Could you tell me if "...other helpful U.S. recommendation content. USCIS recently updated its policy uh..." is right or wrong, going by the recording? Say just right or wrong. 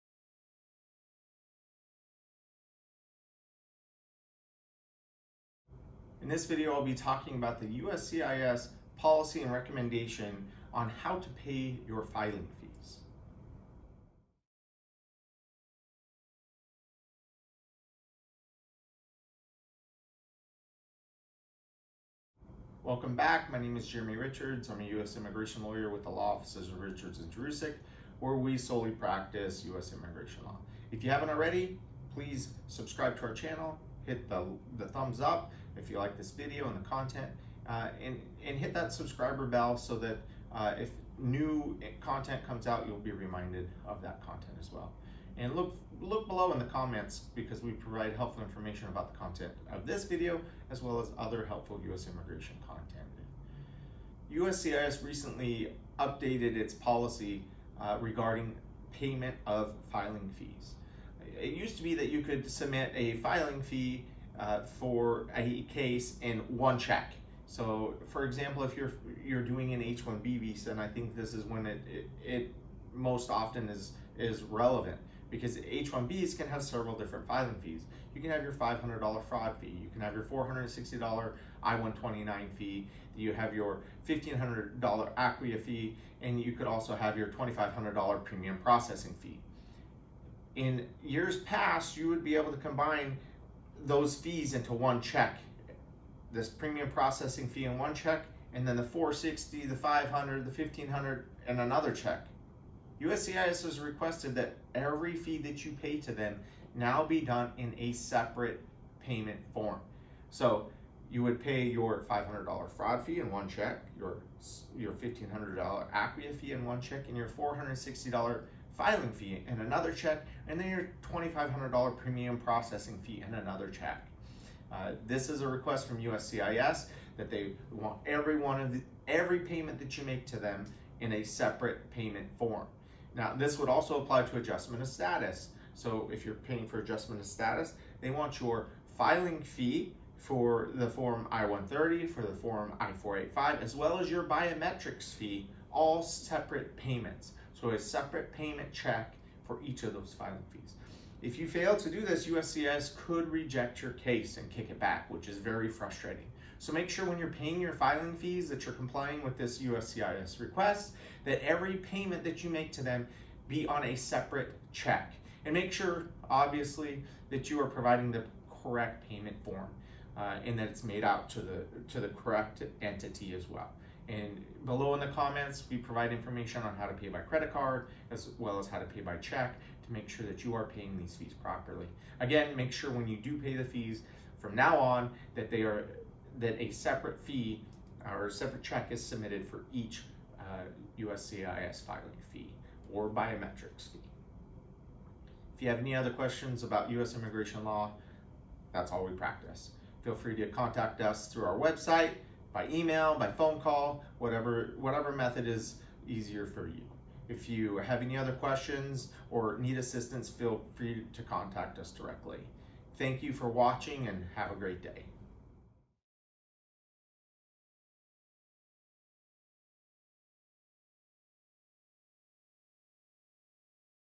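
wrong.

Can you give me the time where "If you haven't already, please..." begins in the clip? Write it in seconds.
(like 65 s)
30 s.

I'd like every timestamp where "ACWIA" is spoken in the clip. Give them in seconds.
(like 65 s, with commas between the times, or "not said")
85 s, 115 s.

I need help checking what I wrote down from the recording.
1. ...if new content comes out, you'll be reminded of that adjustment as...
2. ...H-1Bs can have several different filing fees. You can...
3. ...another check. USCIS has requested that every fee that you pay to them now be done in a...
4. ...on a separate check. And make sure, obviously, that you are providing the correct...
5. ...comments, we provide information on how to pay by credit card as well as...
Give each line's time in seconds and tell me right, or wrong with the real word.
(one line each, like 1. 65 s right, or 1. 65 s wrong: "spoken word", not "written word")
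1. 40 s wrong: "content", not "adjustment"
2. 75 s right
3. 101 s right
4. 163 s right
5. 175 s right.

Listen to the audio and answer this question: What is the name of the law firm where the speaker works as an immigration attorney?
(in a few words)
Richards and Jurusik.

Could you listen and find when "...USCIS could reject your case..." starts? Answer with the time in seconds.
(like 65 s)
152 s.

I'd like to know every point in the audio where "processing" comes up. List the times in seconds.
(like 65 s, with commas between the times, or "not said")
88 s, 96 s, 122 s.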